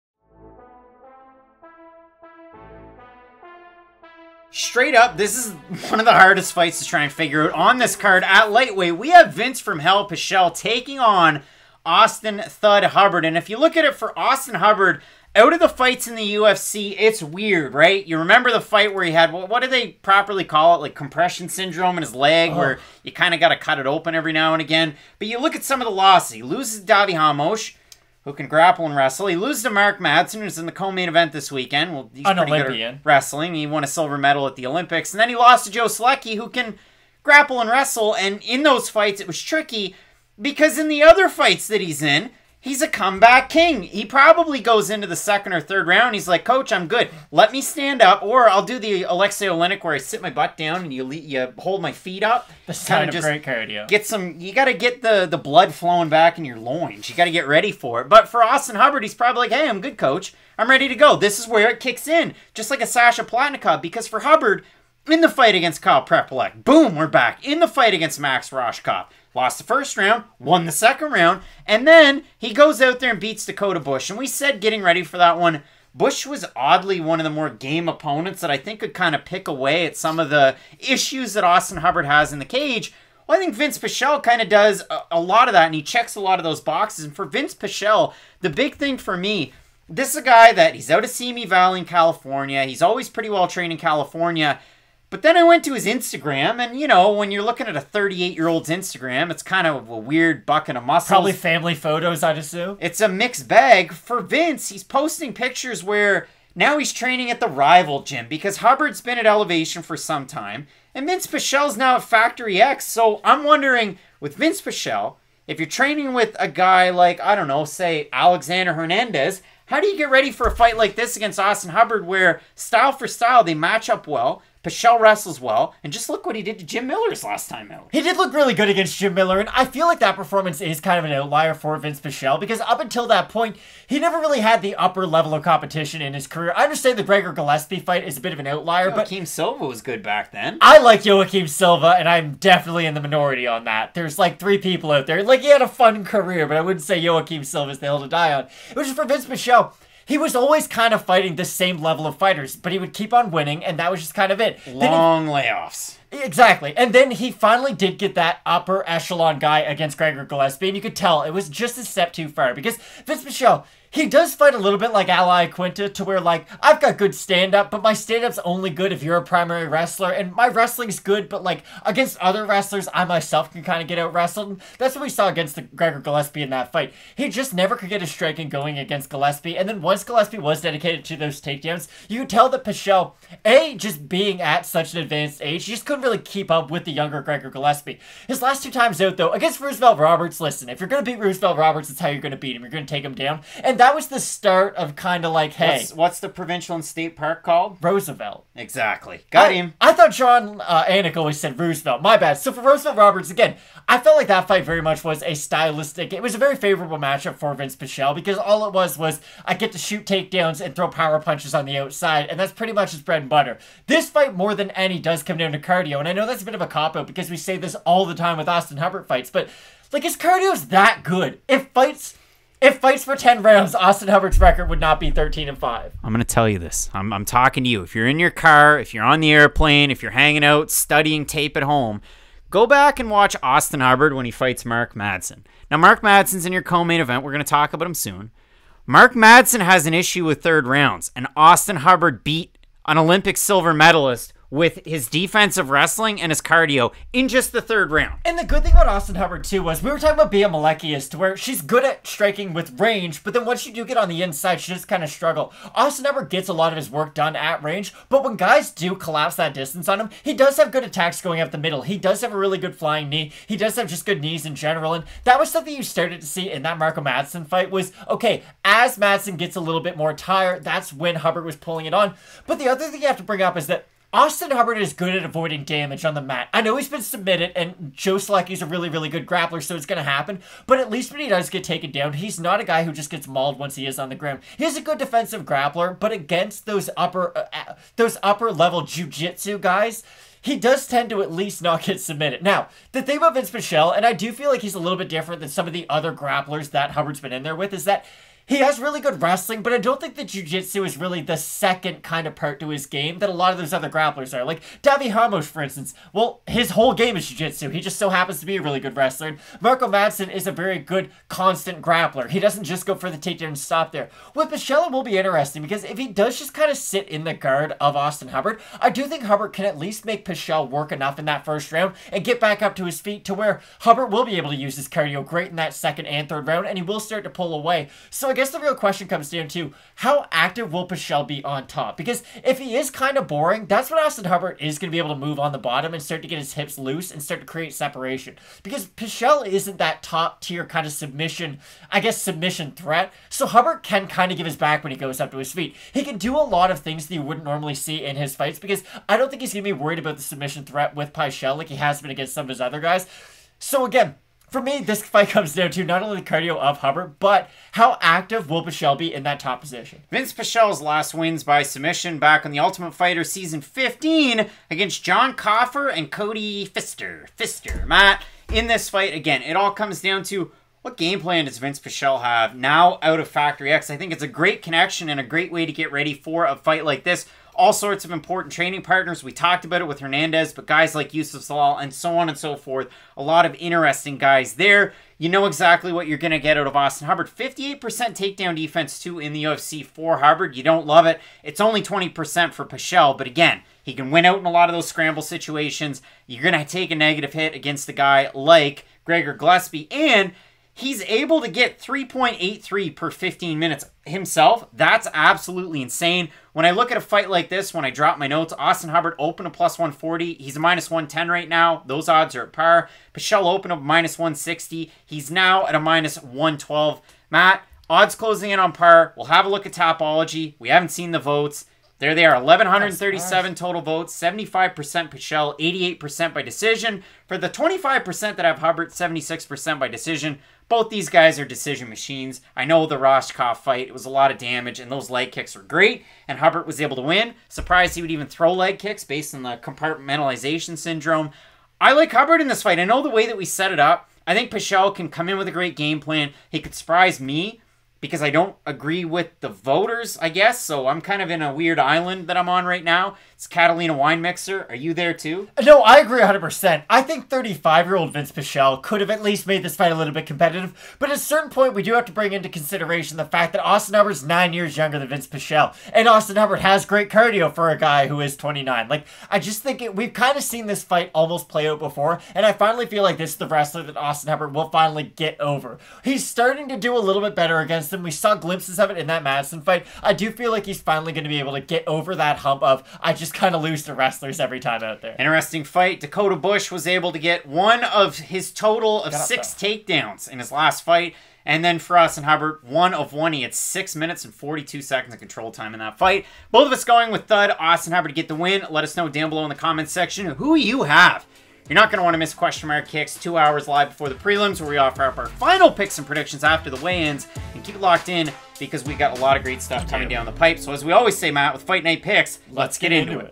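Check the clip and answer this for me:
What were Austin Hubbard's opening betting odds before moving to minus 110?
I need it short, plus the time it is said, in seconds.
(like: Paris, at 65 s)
+140, at 409 s.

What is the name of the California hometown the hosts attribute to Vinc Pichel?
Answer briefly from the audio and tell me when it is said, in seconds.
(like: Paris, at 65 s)
Simi Valley, at 91 s.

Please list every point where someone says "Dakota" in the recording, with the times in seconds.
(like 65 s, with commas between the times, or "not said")
73 s, 485 s.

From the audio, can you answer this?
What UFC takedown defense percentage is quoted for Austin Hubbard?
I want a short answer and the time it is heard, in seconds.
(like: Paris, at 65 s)
58%, at 387 s.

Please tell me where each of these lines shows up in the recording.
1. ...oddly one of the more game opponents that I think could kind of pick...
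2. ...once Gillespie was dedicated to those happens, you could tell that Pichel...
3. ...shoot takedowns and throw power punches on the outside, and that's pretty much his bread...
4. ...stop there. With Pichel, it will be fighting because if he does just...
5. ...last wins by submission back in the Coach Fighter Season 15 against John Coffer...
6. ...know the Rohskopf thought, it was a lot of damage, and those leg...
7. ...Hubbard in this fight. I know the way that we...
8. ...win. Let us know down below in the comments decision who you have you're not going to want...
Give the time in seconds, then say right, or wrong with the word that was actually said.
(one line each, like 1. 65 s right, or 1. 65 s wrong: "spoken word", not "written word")
1. 76 s right
2. 179 s wrong: "takedowns", not "happens"
3. 209 s right
4. 313 s wrong: "interesting", not "fighting"
5. 360 s wrong: "Ultimate", not "Coach"
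6. 432 s wrong: "fight", not "thought"
7. 442 s right
8. 498 s wrong: "section", not "decision".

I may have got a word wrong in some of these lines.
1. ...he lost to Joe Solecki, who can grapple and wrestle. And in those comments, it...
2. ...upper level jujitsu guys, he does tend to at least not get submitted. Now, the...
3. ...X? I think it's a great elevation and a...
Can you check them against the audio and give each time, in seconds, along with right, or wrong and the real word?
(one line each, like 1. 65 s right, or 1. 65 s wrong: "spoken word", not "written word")
1. 35 s wrong: "fights", not "comments"
2. 288 s right
3. 373 s wrong: "connection", not "elevation".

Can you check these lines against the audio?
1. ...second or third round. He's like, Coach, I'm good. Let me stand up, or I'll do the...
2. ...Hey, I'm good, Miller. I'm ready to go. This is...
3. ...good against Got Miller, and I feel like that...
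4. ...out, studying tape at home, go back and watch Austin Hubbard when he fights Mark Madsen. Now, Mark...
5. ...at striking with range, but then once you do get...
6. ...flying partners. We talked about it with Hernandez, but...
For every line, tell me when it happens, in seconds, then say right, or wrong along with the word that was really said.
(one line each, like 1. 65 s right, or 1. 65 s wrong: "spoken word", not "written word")
1. 45 s right
2. 59 s wrong: "Coach", not "Miller"
3. 128 s wrong: "Jim", not "Got"
4. 230 s right
5. 251 s right
6. 378 s wrong: "training", not "flying".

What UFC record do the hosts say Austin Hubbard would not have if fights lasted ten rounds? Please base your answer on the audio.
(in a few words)
13 and 5.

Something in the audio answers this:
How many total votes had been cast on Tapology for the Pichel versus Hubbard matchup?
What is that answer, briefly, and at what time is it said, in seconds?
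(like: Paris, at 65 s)
1,137, at 422 s.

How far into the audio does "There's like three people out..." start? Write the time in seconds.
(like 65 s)
143 s.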